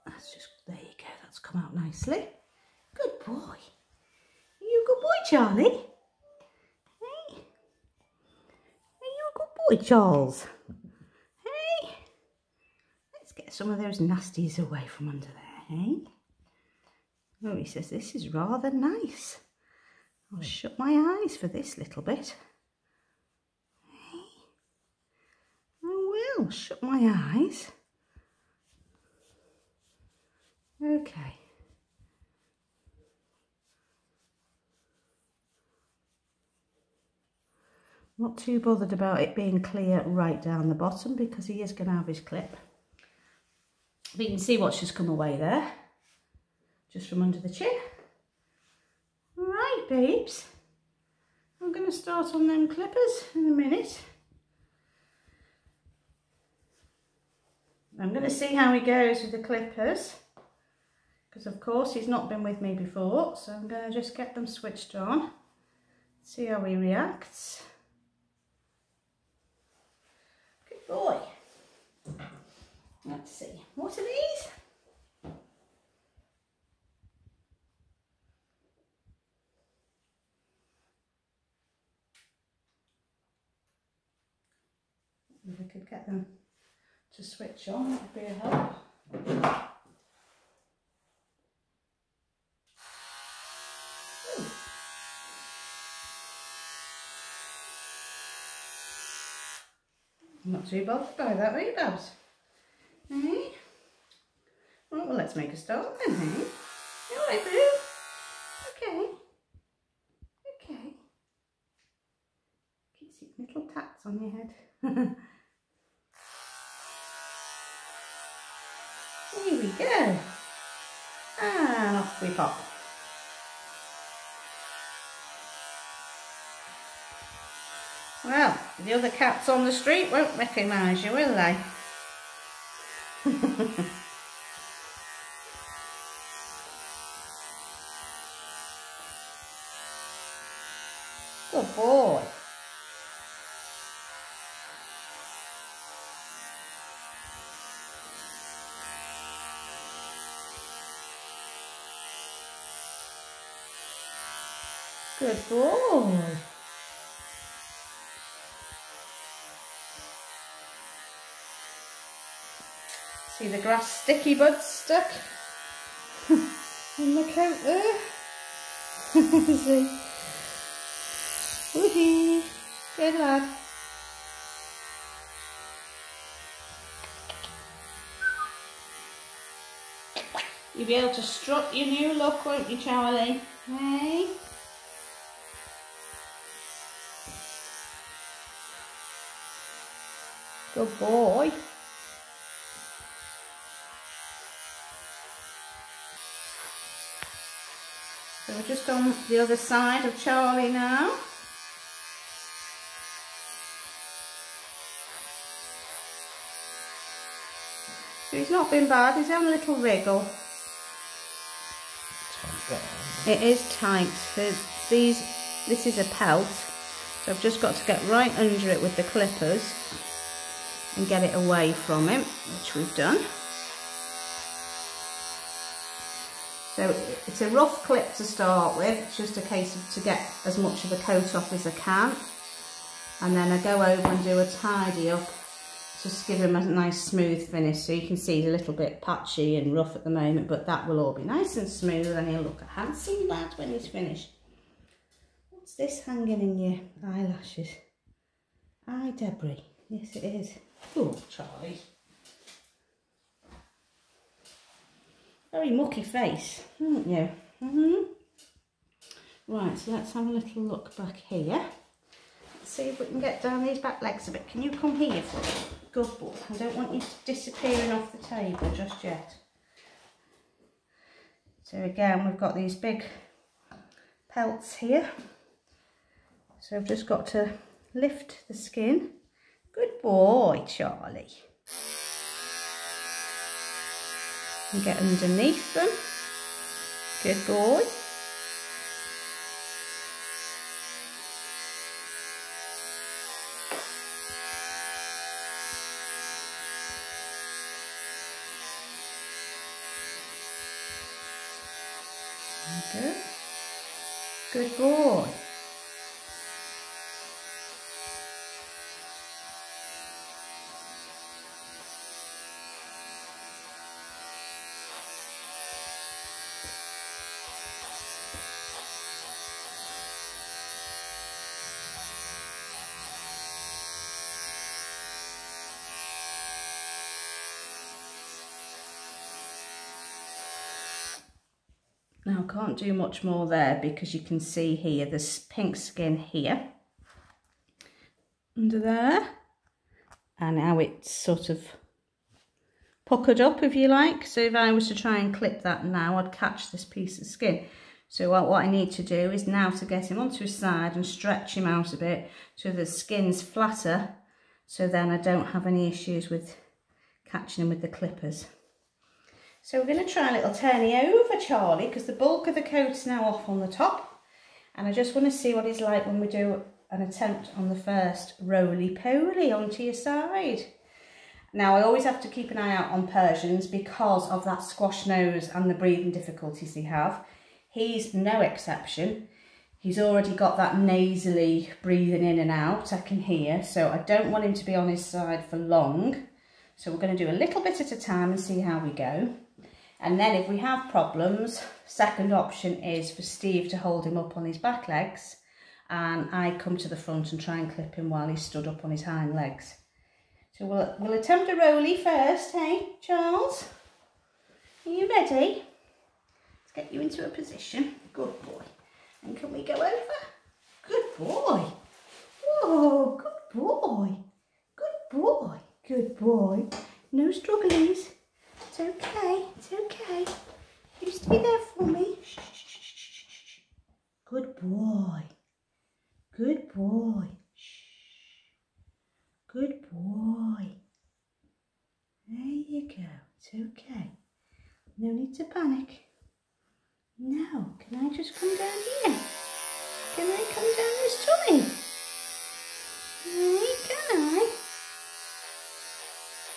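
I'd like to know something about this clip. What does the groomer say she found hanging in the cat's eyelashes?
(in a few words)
Eye debris.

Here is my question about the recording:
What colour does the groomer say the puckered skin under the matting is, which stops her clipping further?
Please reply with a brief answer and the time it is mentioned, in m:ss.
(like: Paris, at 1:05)
pink, at 5:35.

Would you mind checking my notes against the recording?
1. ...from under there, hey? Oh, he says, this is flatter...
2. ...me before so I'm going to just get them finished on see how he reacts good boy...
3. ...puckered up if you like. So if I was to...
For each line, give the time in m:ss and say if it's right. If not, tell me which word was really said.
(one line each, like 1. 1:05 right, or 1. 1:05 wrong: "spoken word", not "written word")
1. 0:14 wrong: "rather", not "flatter"
2. 1:02 wrong: "switched", not "finished"
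3. 5:43 right.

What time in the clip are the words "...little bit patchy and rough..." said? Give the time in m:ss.
3:58.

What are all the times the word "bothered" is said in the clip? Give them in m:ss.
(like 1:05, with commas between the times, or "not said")
0:38, 1:40.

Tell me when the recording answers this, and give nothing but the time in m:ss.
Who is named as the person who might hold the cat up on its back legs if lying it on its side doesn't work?
6:33.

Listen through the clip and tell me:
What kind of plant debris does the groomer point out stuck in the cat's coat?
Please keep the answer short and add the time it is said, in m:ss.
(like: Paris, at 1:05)
grass sticky bud, at 2:43.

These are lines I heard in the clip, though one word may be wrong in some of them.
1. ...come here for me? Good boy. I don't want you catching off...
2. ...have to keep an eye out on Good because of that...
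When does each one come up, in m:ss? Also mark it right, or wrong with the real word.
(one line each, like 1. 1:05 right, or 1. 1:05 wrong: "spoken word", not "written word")
1. 4:24 wrong: "disappearing", not "catching"
2. 6:12 wrong: "Persians", not "Good".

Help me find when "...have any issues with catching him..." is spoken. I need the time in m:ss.
5:55.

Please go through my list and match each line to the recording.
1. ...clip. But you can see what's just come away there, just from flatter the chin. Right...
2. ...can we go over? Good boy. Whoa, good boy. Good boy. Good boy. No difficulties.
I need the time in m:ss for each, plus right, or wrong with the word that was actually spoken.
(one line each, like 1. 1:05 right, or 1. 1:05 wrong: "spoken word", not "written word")
1. 0:42 wrong: "under", not "flatter"
2. 6:49 wrong: "strugglies", not "difficulties".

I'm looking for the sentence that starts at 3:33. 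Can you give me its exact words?
It is tight, so these, this is a pelt.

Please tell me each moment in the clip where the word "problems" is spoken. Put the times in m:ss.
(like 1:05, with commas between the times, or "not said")
6:30.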